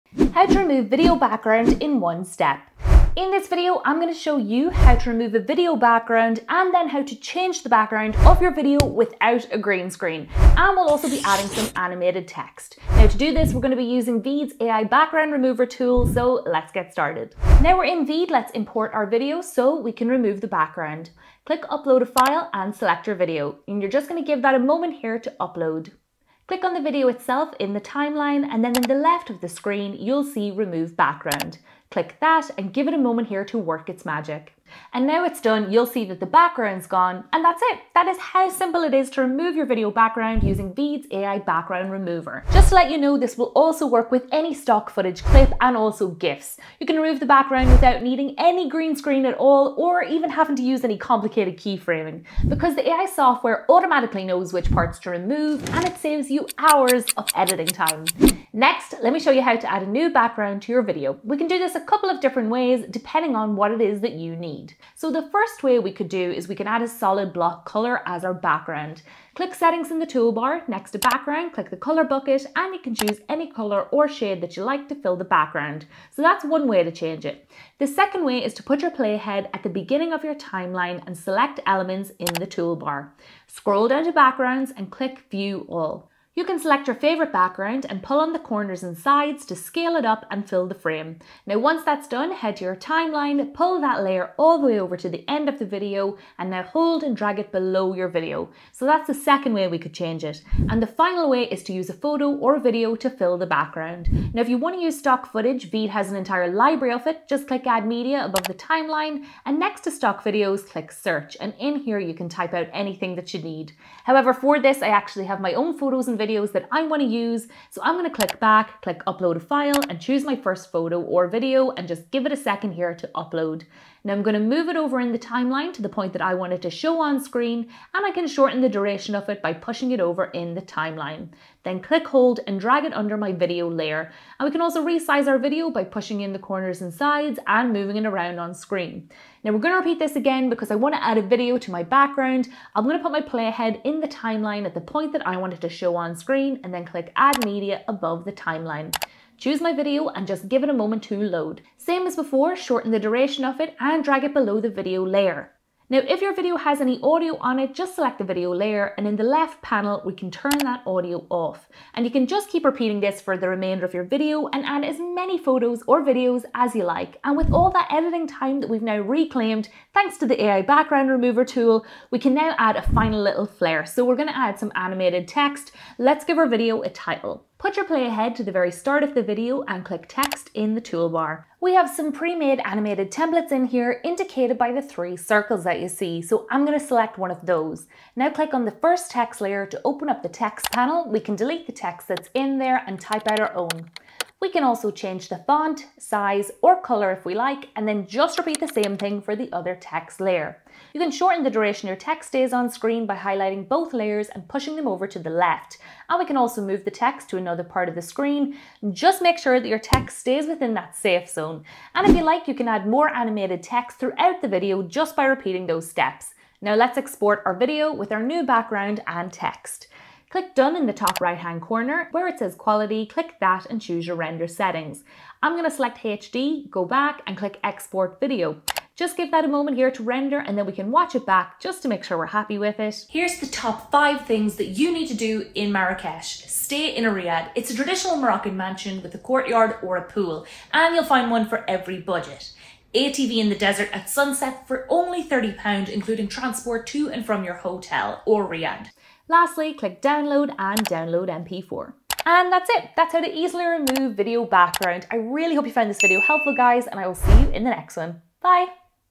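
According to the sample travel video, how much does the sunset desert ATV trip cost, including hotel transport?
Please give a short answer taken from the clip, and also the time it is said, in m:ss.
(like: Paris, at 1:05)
£30, at 4:05.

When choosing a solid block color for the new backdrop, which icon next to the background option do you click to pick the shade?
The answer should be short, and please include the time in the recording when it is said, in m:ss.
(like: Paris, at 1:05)
color bucket, at 1:11.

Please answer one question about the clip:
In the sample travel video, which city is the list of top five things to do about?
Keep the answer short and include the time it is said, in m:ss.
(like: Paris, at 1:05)
Marrakesh, at 3:55.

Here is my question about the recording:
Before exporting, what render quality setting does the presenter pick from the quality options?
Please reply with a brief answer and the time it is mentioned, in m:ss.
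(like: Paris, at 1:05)
HD, at 3:45.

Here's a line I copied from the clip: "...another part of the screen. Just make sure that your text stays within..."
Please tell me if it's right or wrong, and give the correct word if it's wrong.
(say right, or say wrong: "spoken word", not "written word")
right.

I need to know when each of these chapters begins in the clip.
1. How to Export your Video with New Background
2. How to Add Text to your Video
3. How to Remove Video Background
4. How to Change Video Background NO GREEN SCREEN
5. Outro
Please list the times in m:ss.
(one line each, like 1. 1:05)
1. 3:39
2. 2:57
3. 0:17
4. 0:58
5. 4:12.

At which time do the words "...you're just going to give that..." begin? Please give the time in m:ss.
0:23.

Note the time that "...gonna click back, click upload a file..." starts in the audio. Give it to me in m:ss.
1:57.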